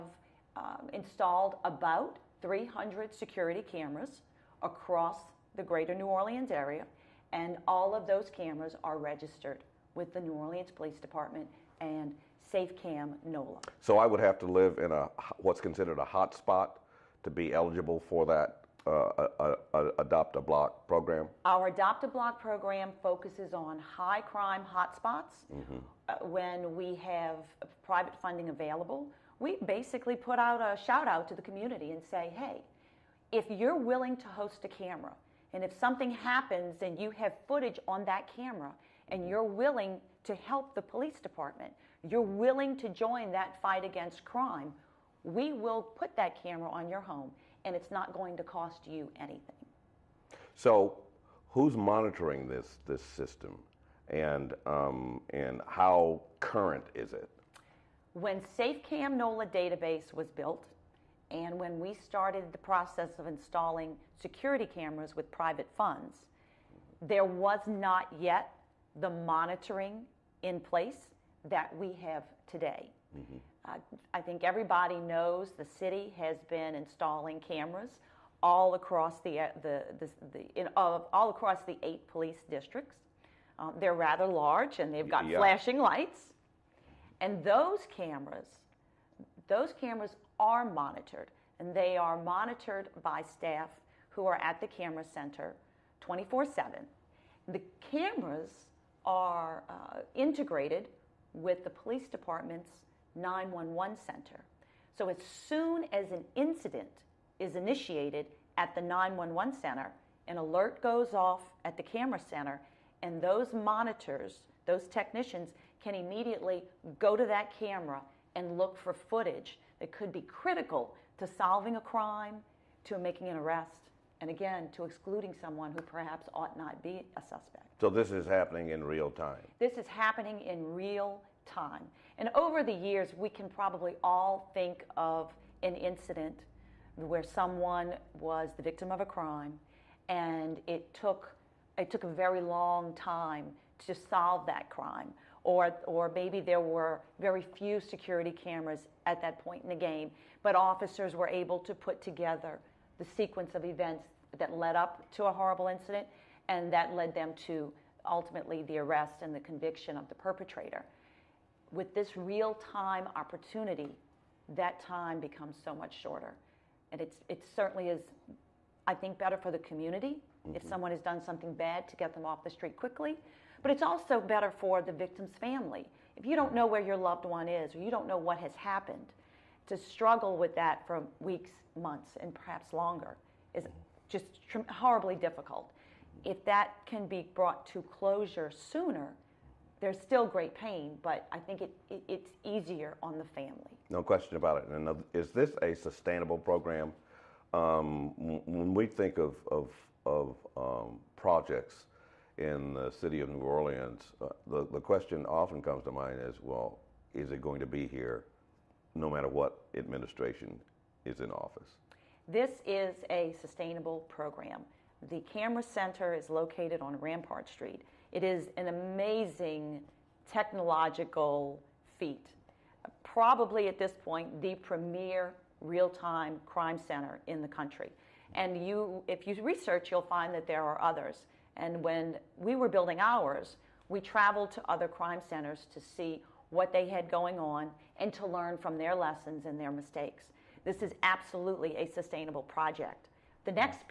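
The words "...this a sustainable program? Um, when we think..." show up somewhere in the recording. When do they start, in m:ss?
3:15.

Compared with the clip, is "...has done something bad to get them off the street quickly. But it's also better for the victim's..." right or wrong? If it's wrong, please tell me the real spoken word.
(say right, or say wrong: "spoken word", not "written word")
right.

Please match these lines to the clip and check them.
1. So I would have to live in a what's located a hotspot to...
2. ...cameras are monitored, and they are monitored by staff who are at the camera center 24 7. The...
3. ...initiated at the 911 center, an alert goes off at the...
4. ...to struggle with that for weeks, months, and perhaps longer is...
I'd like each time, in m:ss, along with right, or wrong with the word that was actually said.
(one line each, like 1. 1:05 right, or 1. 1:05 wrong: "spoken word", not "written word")
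1. 0:13 wrong: "considered", not "located"
2. 1:29 right
3. 1:47 right
4. 2:59 right.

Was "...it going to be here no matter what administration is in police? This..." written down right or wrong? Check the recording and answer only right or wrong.
wrong.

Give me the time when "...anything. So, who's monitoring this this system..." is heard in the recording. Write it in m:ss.
0:49.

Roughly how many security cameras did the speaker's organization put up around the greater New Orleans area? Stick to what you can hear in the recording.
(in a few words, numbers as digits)
300.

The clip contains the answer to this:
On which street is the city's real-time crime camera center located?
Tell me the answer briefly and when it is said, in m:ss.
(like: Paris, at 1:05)
Rampart Street, at 3:36.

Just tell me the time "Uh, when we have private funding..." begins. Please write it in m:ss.
0:26.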